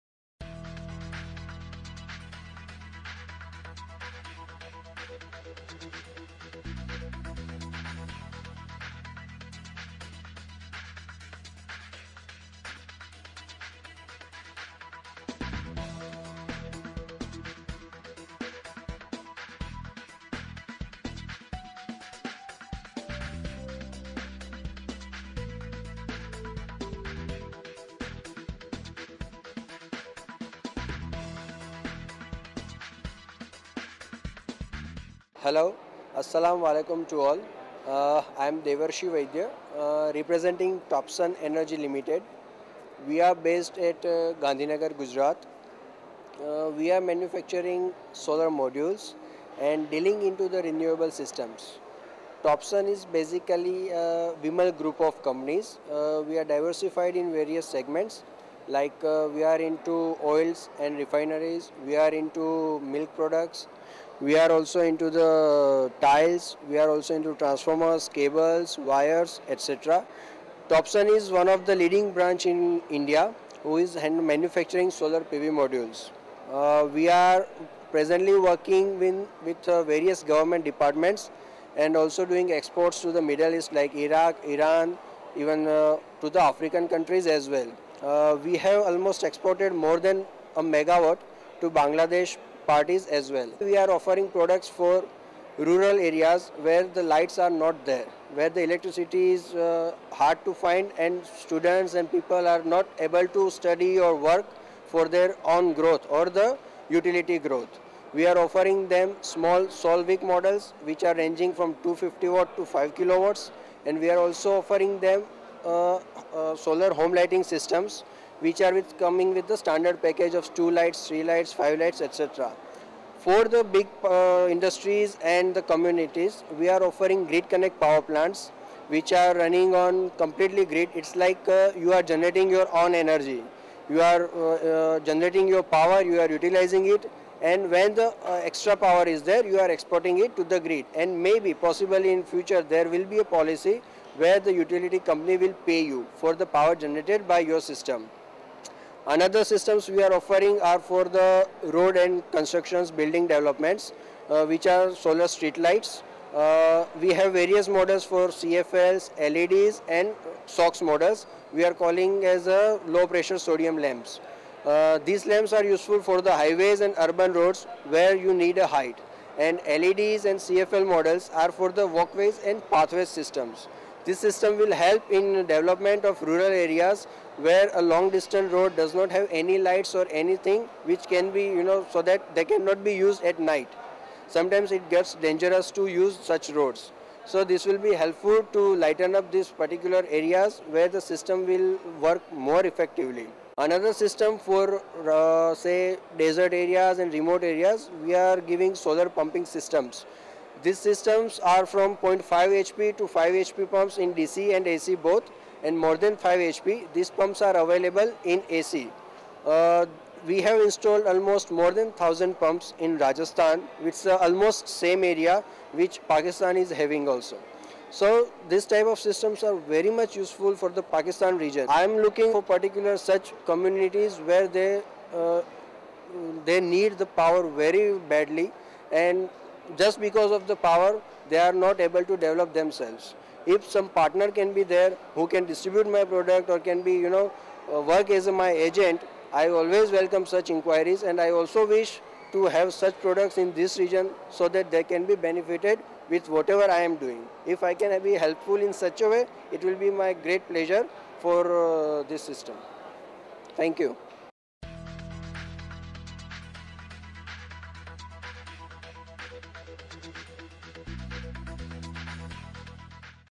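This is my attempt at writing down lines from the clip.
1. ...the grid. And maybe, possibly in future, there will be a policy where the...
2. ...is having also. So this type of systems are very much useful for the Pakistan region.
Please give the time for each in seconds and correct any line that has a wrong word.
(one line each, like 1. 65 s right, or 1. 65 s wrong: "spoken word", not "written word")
1. 140 s right
2. 216 s right.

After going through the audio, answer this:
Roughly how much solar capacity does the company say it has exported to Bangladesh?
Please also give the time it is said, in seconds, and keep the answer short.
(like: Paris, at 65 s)
more than a megawatt, at 89 s.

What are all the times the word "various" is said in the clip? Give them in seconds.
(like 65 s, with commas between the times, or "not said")
57 s, 79 s, 157 s.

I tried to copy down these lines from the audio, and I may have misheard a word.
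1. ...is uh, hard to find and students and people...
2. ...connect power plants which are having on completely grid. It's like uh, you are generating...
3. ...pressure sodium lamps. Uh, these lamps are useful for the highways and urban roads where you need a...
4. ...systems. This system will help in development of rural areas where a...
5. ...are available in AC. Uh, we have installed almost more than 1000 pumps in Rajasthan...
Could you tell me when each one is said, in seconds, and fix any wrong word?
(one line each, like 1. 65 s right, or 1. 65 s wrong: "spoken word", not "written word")
1. 99 s right
2. 127 s wrong: "running", not "having"
3. 163 s right
4. 173 s right
5. 207 s right.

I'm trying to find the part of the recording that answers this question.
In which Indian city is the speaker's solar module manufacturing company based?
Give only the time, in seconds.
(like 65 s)
44 s.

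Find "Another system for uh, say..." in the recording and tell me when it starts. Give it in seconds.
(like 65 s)
193 s.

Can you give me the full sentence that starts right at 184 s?
Sometimes it gets dangerous to use such roads.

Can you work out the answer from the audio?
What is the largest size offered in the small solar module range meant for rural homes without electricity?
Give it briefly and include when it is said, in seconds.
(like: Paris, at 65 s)
5 kilowatts, at 112 s.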